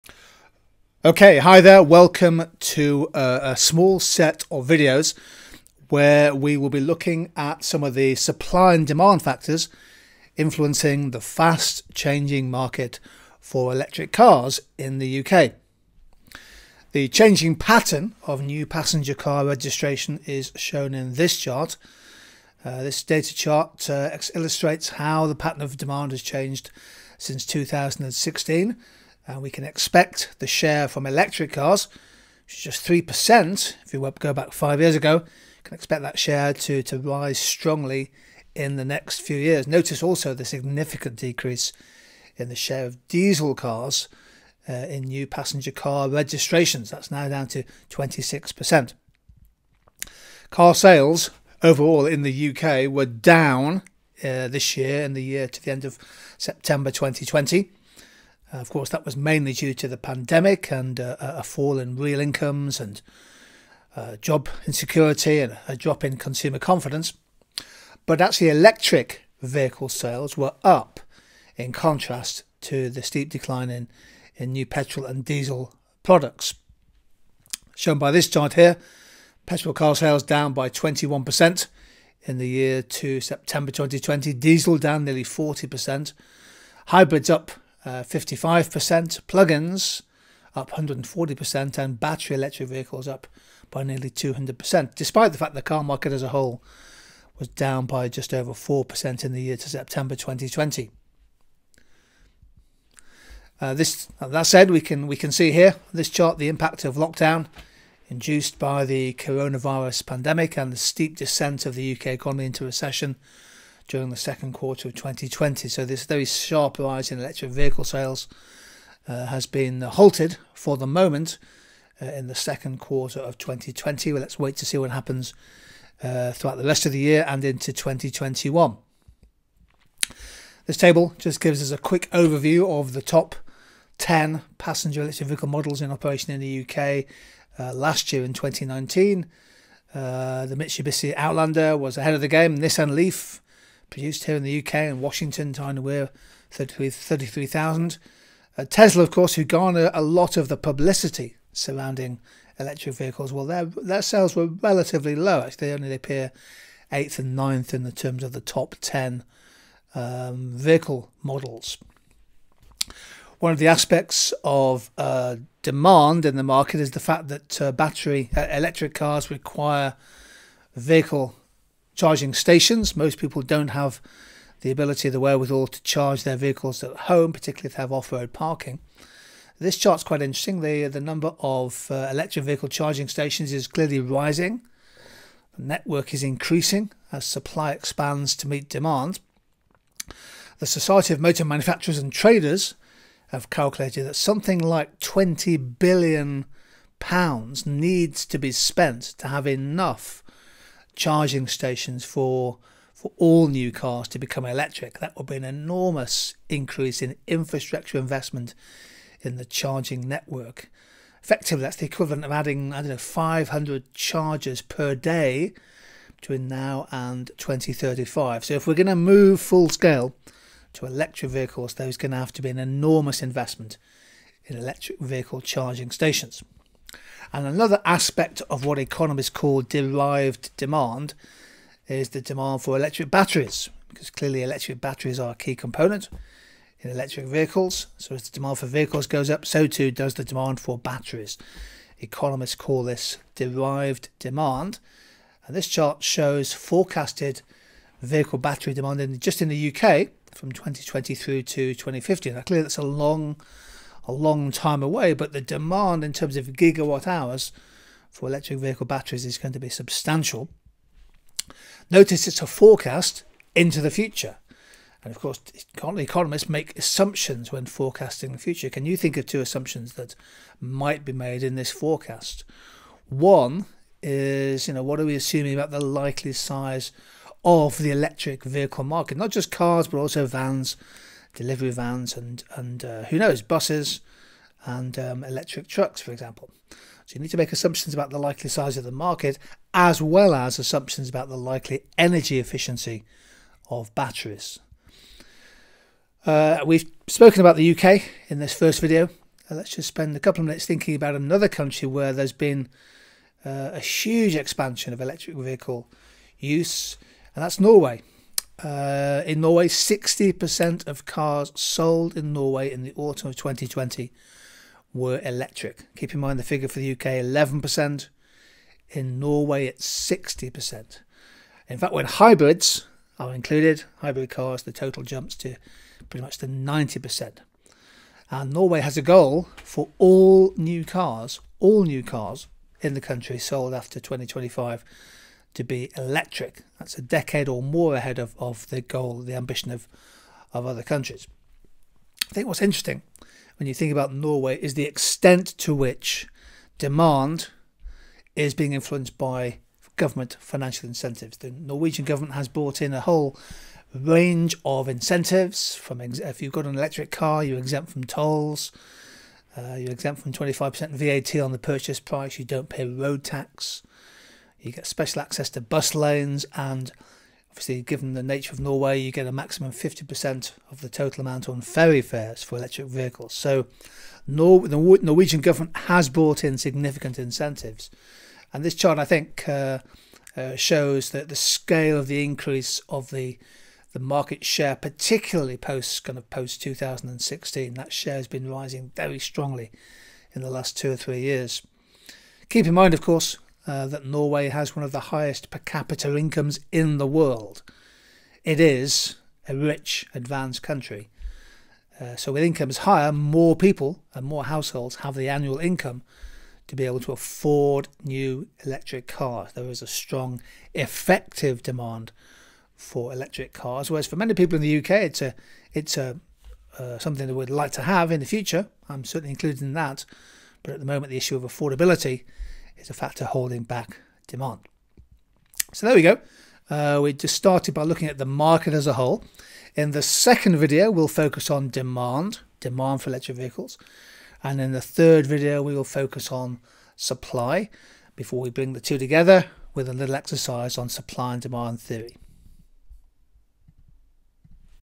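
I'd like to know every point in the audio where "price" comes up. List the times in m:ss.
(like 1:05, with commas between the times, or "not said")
6:01.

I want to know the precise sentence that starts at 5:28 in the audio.
And Norway has a goal for all new cars, all new cars in the country sold after 2025 to be electric.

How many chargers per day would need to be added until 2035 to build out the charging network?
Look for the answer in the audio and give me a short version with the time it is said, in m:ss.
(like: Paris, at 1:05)
500, at 3:32.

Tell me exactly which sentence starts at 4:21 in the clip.
Notice it's a forecast into the future.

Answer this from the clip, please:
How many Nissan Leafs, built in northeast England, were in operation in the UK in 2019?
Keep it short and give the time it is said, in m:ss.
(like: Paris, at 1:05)
33,000, at 2:26.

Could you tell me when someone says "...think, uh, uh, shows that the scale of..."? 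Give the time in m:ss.
6:19.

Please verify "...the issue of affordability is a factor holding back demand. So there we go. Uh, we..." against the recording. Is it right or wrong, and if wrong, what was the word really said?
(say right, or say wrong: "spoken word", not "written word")
right.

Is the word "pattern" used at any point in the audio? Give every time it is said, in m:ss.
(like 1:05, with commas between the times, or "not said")
0:17, 0:25.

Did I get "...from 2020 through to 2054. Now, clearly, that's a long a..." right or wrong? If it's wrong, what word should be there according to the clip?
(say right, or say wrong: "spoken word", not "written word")
wrong: "2050", not "2054".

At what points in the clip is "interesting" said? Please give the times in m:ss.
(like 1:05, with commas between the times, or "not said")
3:00, 5:42.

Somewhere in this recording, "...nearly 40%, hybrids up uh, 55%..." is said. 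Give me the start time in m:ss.
1:25.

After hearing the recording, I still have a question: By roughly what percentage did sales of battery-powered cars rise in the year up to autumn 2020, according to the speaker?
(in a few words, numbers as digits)
nearly 200%.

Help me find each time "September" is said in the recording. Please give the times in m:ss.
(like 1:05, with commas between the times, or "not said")
0:56, 1:23, 1:39.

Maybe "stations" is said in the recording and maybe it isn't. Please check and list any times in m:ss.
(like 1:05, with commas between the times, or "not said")
2:52, 3:03, 3:21, 3:45.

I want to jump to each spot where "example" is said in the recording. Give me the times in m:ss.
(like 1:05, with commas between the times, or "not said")
4:46.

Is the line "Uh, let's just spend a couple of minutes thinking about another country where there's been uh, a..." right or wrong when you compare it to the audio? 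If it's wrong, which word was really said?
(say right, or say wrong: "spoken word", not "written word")
right.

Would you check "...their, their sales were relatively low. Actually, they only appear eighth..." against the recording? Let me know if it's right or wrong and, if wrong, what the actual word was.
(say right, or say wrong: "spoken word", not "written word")
right.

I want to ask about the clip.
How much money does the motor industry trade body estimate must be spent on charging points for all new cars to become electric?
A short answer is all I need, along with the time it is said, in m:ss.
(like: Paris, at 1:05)
20 billion pounds, at 3:14.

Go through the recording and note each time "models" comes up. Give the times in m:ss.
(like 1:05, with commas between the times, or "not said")
2:15, 2:41.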